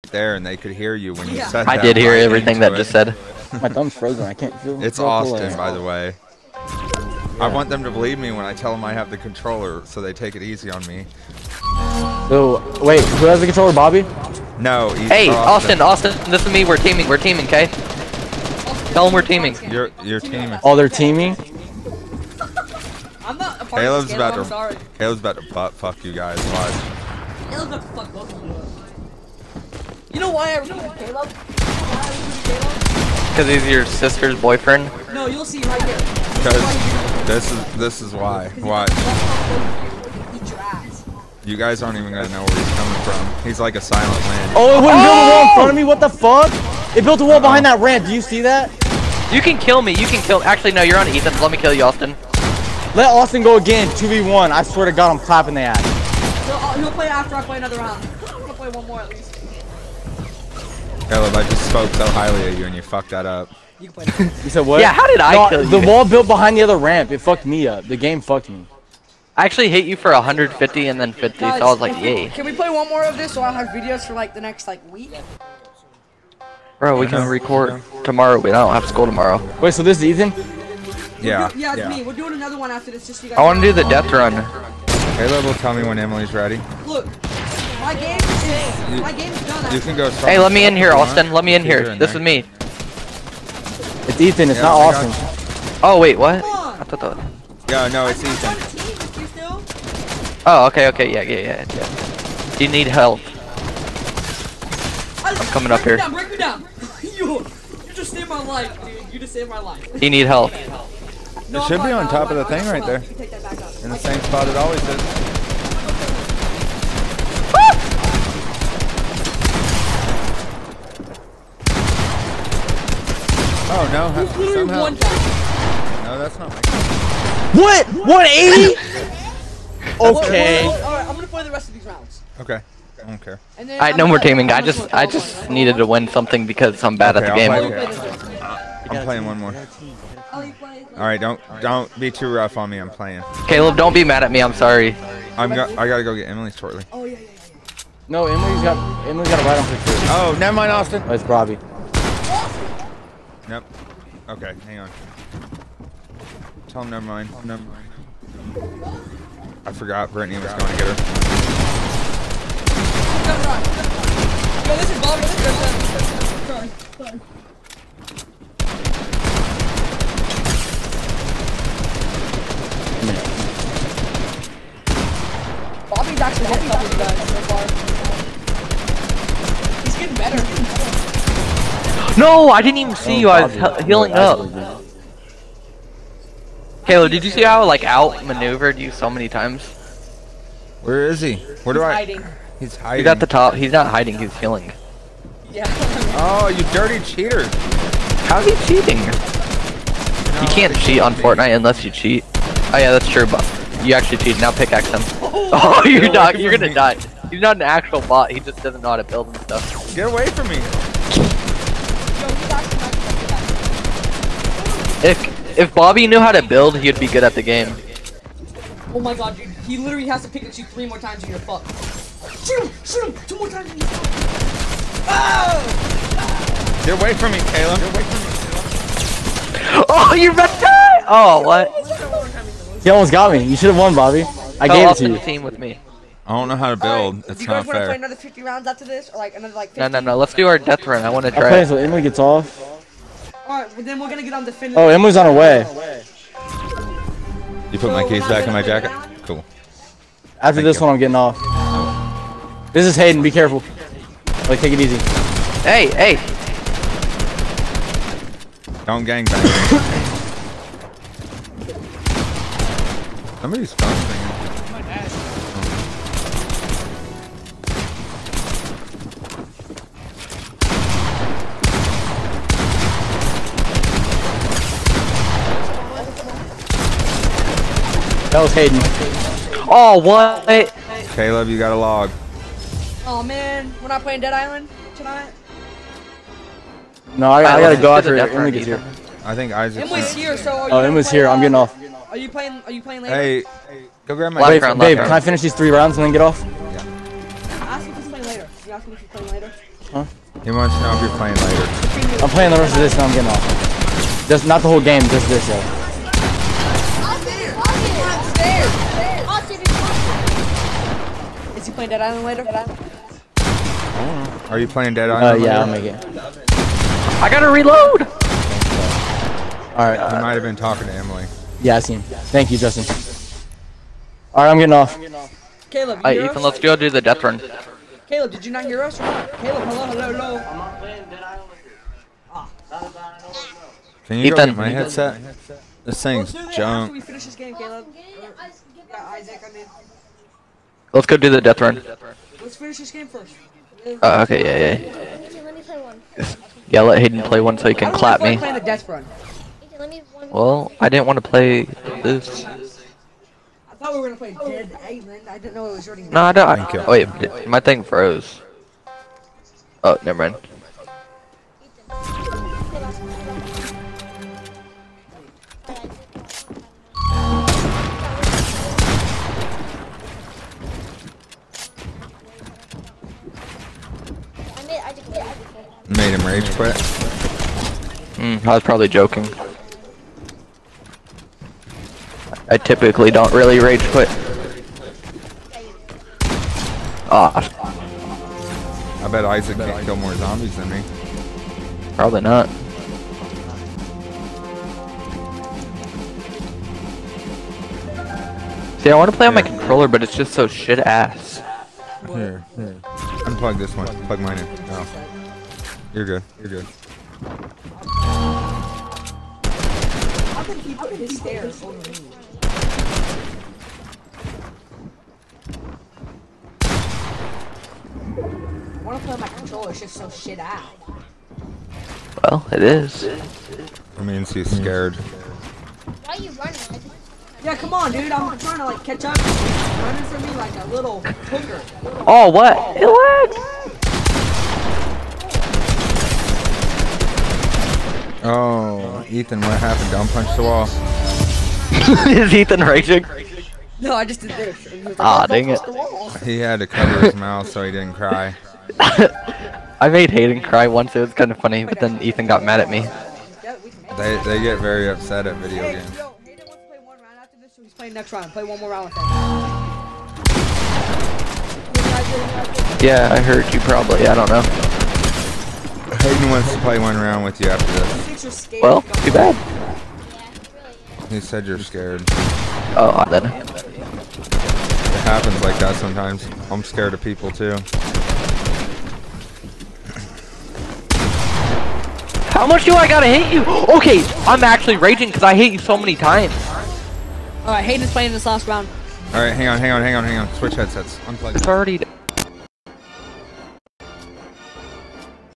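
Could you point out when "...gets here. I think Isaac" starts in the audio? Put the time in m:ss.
4:48.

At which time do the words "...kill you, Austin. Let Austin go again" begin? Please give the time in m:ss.
0:51.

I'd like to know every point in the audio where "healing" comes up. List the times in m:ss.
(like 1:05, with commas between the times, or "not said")
3:03, 3:14.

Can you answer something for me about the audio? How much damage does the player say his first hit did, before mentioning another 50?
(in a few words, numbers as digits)
150.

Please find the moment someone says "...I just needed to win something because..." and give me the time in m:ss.
2:14.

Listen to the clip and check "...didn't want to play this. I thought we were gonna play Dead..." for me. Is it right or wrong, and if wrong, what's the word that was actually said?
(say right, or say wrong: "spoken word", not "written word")
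right.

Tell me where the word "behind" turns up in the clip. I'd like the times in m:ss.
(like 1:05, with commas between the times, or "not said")
0:47, 1:06.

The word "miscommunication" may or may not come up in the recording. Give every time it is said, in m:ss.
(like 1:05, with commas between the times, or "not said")
not said.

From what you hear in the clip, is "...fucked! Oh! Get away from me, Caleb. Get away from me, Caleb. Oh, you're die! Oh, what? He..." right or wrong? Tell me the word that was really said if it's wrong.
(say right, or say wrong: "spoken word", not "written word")
right.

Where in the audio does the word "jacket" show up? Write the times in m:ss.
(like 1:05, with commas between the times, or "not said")
4:08.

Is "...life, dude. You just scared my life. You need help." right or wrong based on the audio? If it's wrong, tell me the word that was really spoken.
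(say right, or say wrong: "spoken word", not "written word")
wrong: "saved", not "scared".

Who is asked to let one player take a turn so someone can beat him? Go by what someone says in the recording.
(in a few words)
AJ.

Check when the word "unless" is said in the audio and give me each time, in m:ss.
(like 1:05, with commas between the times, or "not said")
3:21.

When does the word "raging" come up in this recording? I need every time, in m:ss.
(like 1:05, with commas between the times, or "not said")
7:22, 8:04.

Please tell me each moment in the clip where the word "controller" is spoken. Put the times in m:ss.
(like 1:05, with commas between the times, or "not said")
0:09, 0:13, 6:39, 6:59.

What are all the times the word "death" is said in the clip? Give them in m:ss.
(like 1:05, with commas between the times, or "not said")
1:23, 4:00, 5:26, 5:41.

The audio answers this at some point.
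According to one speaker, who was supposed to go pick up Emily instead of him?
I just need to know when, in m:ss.
2:40.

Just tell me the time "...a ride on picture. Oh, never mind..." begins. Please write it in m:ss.
2:29.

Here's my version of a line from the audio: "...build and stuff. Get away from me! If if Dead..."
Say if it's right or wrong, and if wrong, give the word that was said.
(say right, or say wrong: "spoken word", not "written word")
wrong: "Bobby", not "Dead".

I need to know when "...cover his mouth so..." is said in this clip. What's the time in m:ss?
7:26.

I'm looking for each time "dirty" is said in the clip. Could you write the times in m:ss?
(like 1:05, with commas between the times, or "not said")
3:16.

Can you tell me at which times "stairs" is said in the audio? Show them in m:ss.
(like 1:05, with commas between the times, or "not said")
6:51.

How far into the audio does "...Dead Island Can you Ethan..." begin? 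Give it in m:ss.
5:31.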